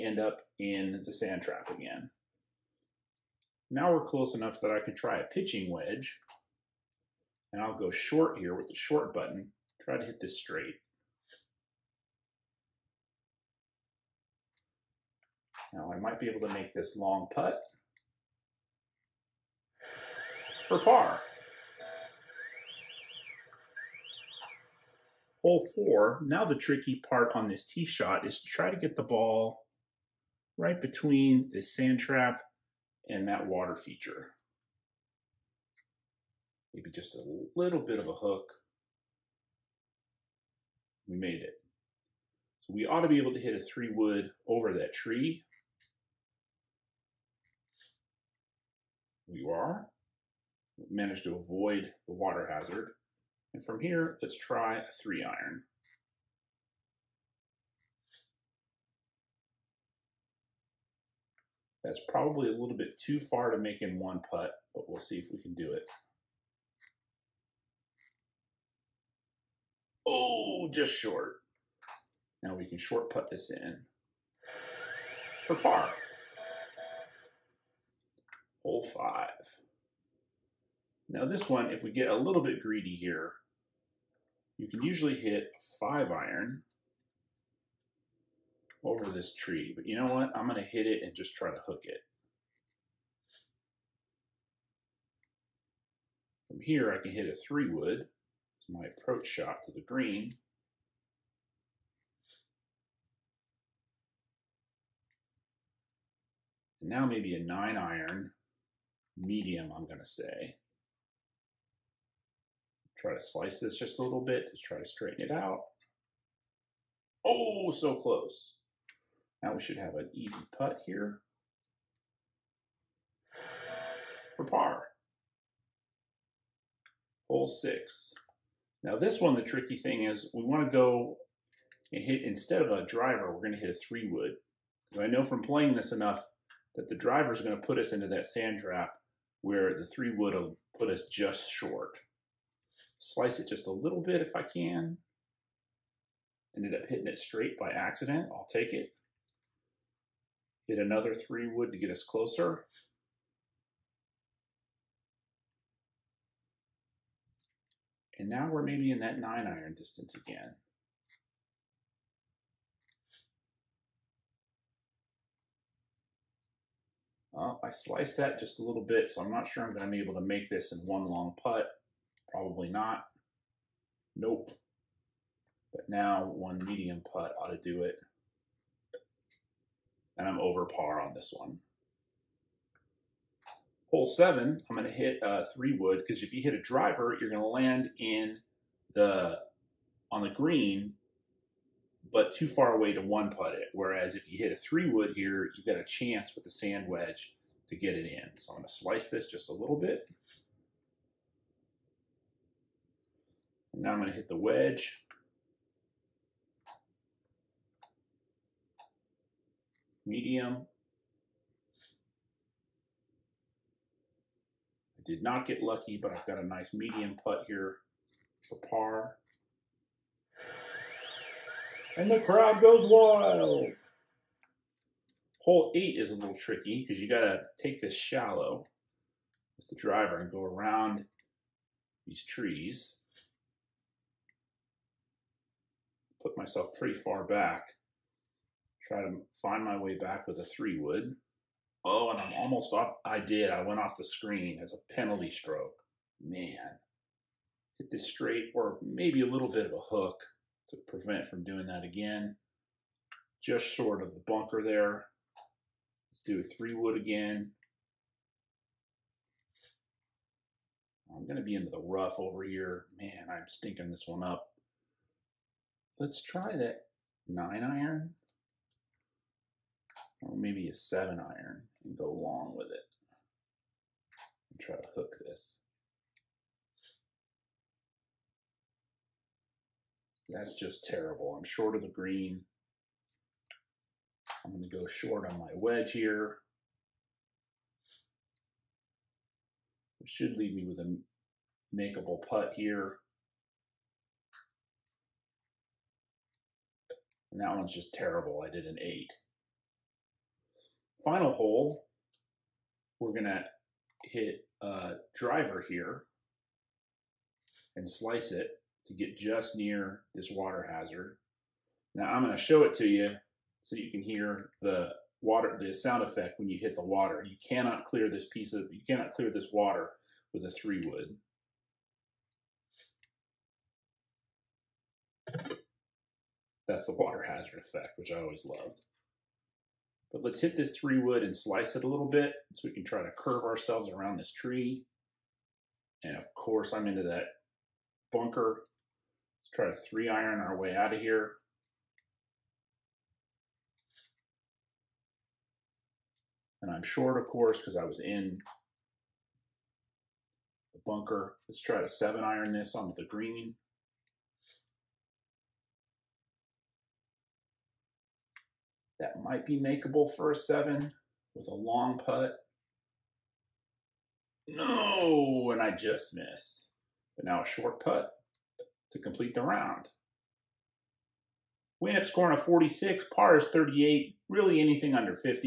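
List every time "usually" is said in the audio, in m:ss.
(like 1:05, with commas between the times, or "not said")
1:24.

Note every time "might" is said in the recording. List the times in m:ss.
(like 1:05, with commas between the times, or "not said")
0:15, 5:59.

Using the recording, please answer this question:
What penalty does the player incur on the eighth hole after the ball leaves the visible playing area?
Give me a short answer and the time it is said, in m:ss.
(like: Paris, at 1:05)
penalty stroke, at 4:04.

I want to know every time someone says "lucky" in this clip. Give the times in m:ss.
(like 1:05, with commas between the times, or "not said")
3:35.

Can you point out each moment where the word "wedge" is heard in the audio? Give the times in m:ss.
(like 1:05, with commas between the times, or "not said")
0:05, 3:16, 3:24, 4:45.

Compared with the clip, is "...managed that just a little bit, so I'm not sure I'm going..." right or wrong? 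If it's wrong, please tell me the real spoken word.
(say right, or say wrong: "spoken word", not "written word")
wrong: "sliced", not "managed".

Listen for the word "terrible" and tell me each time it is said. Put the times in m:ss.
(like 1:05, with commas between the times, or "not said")
4:40, 4:57.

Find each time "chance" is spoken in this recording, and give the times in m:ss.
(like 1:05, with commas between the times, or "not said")
3:15.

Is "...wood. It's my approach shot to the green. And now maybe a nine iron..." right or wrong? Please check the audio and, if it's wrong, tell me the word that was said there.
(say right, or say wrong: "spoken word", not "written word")
right.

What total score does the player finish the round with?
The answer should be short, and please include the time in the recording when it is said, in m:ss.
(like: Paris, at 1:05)
46, at 6:12.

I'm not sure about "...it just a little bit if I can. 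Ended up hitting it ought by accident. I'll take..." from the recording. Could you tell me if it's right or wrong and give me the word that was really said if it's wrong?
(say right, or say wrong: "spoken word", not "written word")
wrong: "straight", not "ought".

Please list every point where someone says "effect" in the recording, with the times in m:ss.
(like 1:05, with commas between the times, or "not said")
5:16, 5:27.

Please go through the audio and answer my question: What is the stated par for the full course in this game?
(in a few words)
38.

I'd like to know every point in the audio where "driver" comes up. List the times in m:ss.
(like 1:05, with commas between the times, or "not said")
2:12, 2:16, 3:06, 3:49, 5:05.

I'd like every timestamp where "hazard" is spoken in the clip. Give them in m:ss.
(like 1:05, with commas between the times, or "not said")
0:52, 5:10, 5:27.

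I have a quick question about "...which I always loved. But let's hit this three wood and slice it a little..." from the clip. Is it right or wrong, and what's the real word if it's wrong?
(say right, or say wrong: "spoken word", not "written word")
right.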